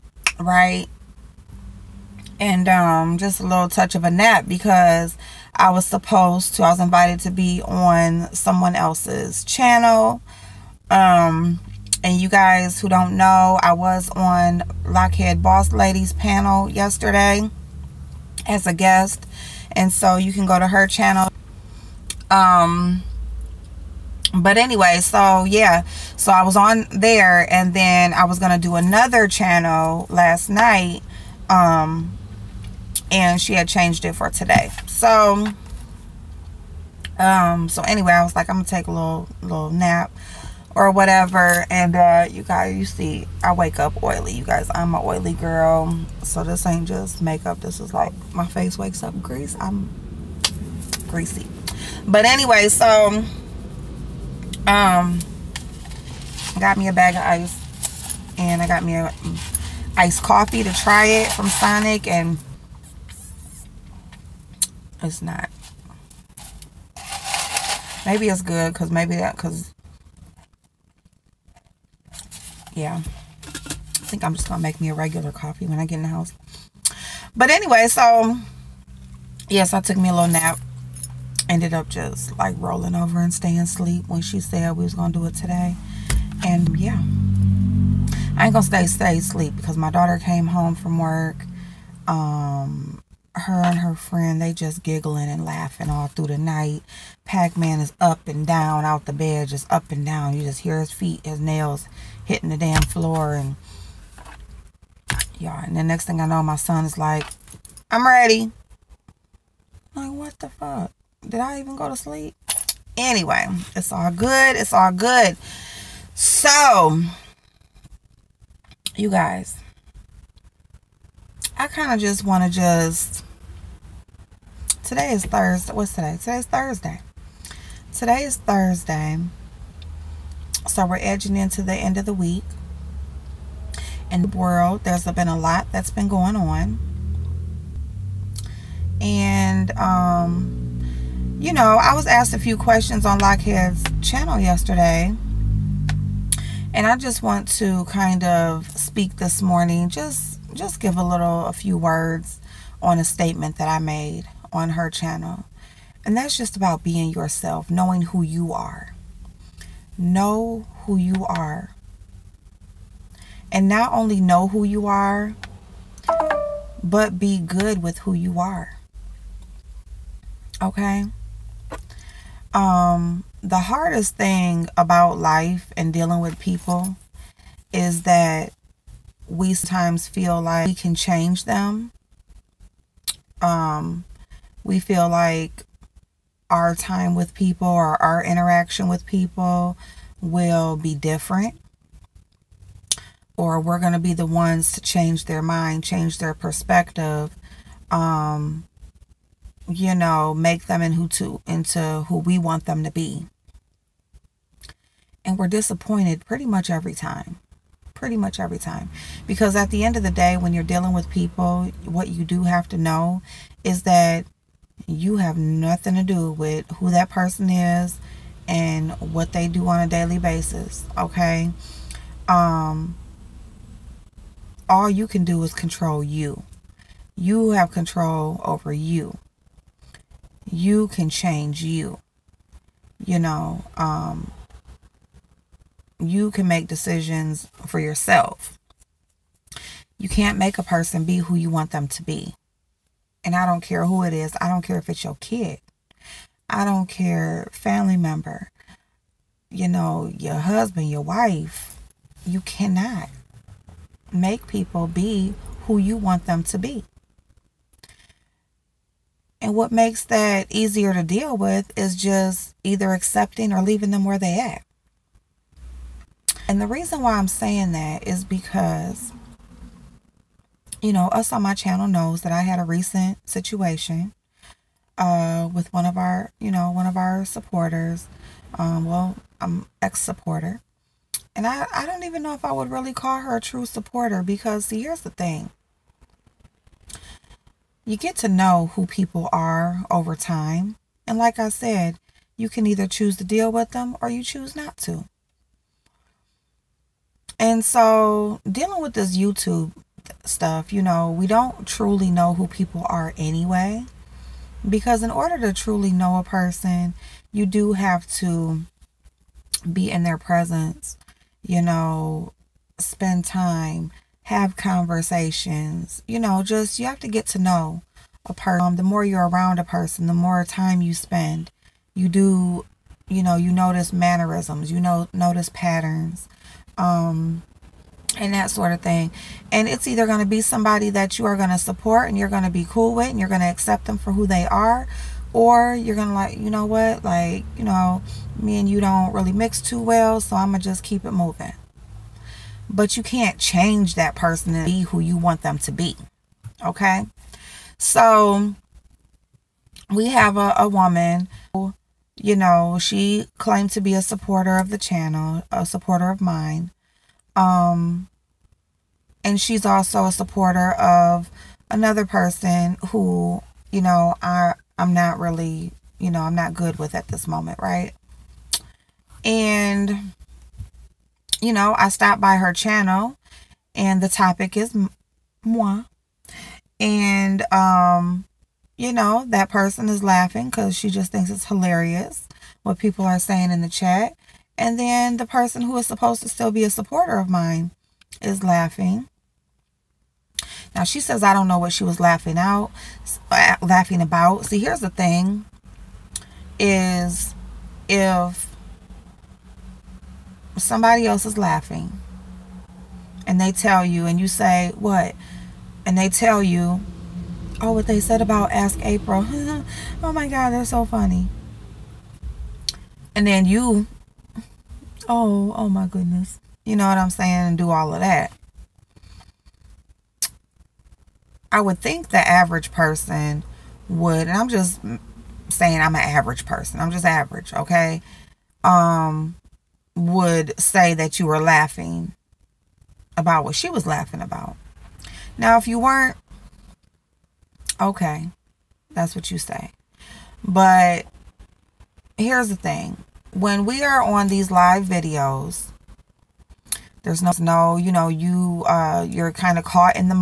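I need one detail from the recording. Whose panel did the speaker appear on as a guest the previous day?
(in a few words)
Lockheed Boss Ladies.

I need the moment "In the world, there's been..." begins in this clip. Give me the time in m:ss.
2:14.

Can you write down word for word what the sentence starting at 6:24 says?
And then the person who is supposed to still be a supporter of mine is laughing.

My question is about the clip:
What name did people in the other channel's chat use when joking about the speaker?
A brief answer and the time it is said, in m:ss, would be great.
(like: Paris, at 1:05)
Ask April, at 6:48.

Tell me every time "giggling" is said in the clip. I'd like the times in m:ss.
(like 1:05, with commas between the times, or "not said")
1:34.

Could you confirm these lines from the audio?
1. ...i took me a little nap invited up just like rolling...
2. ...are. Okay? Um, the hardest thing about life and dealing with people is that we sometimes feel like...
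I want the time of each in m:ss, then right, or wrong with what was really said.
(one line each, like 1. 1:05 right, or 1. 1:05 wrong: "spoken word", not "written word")
1. 1:19 wrong: "ended", not "invited"
2. 2:48 right.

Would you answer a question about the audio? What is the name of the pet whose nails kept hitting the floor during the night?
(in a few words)
Pac-Man.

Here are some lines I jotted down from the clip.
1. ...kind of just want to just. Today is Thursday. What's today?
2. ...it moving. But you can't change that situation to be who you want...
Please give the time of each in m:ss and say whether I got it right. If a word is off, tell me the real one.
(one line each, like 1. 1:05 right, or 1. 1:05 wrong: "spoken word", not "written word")
1. 2:01 right
2. 5:41 wrong: "person", not "situation".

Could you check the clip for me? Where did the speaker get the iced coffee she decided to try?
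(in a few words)
Sonic.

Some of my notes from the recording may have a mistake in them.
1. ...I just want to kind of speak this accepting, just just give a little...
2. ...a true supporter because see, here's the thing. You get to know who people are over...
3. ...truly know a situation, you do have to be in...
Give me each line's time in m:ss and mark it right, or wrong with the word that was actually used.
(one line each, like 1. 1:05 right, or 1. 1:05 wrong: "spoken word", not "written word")
1. 2:26 wrong: "morning", not "accepting"
2. 4:43 right
3. 5:05 wrong: "person", not "situation".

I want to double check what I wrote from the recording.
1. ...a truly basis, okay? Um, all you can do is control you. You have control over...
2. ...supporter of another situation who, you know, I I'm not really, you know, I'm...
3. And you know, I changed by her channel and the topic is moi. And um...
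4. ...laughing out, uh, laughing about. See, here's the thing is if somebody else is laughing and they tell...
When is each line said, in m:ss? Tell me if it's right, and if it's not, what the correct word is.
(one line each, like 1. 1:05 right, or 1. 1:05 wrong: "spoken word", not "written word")
1. 3:39 wrong: "daily", not "truly"
2. 6:00 wrong: "person", not "situation"
3. 6:09 wrong: "stopped", not "changed"
4. 6:31 right.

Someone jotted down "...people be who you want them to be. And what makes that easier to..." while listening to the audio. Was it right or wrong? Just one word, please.
right.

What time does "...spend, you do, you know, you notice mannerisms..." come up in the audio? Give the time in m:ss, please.
5:20.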